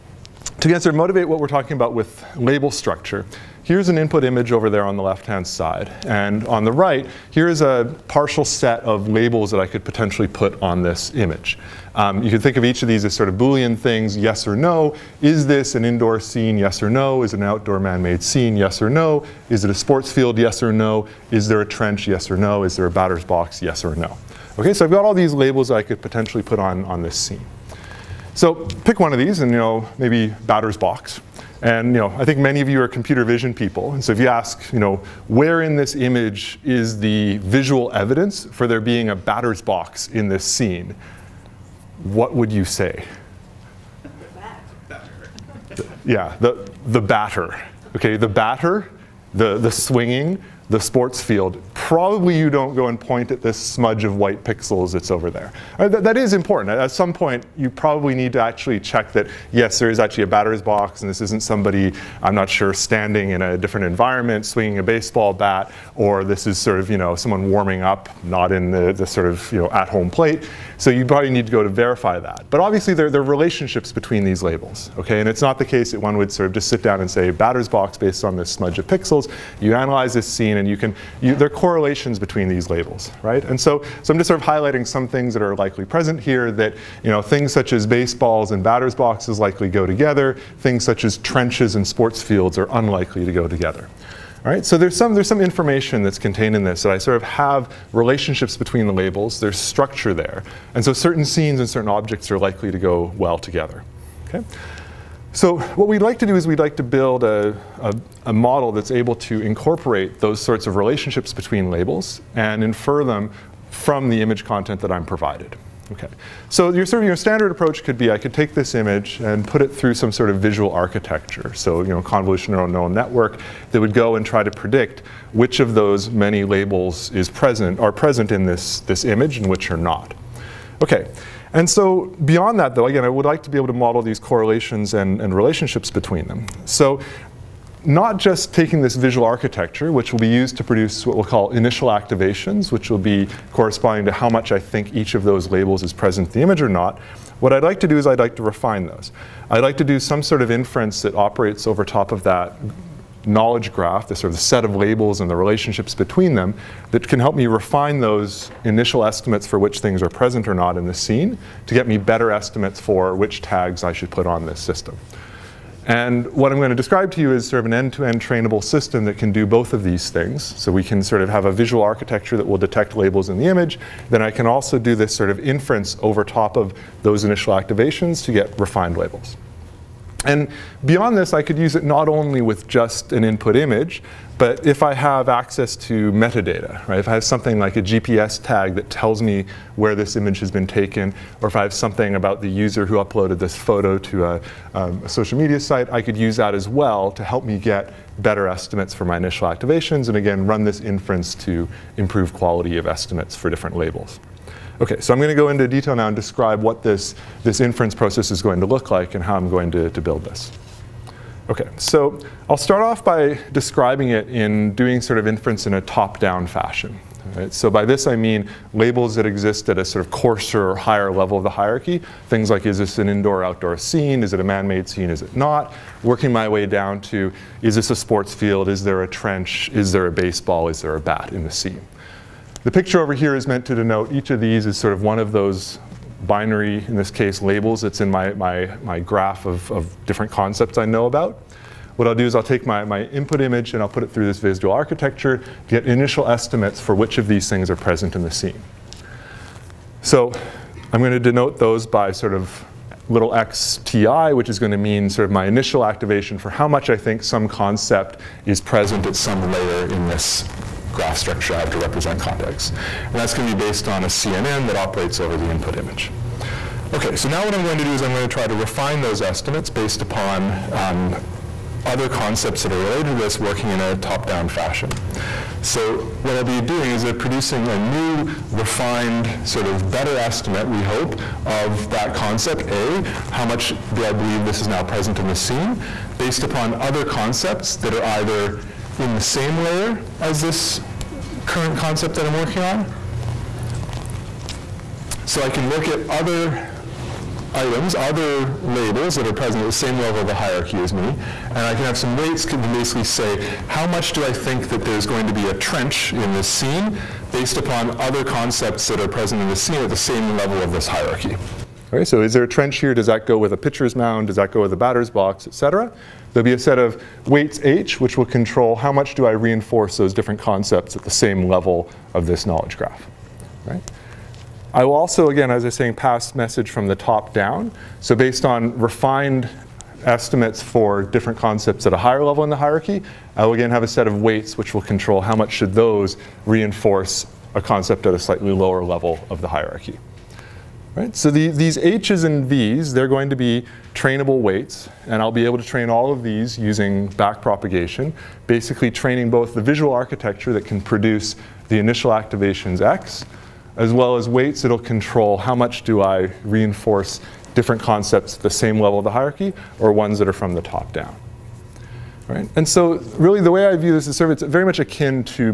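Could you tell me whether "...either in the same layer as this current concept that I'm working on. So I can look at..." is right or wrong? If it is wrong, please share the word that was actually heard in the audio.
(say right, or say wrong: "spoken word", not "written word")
right.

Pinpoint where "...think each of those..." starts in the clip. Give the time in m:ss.
2:24.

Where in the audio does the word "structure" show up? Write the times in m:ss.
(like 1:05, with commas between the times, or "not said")
0:02, 1:39, 4:21.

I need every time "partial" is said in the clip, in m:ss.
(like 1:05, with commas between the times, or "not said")
0:08.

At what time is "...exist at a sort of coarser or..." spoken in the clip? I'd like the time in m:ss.
3:39.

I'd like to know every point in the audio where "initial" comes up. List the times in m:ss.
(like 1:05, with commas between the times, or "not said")
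2:21, 2:38, 2:57, 3:19, 4:05, 4:15, 5:51.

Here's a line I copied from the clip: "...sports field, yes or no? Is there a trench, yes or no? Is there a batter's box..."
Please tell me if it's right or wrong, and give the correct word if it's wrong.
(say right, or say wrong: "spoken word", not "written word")
right.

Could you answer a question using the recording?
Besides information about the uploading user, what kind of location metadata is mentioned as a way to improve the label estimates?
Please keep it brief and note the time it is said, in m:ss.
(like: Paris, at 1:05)
GPS tag, at 3:07.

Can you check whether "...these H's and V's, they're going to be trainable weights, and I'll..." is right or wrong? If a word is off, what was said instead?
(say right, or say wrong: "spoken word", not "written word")
right.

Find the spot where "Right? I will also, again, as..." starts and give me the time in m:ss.
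5:23.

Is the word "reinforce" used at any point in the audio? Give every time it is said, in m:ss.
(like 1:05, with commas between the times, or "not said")
5:19, 5:36, 5:56.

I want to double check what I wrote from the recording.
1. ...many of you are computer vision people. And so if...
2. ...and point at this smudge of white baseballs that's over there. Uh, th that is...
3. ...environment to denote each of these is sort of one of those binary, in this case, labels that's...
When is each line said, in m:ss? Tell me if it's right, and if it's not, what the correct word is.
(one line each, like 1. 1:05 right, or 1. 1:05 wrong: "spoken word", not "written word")
1. 0:32 right
2. 0:52 wrong: "pixels", not "baseballs"
3. 3:53 wrong: "meant", not "environment".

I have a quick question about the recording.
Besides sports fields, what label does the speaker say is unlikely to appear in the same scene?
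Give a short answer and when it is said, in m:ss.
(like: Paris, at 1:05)
trenches, at 1:31.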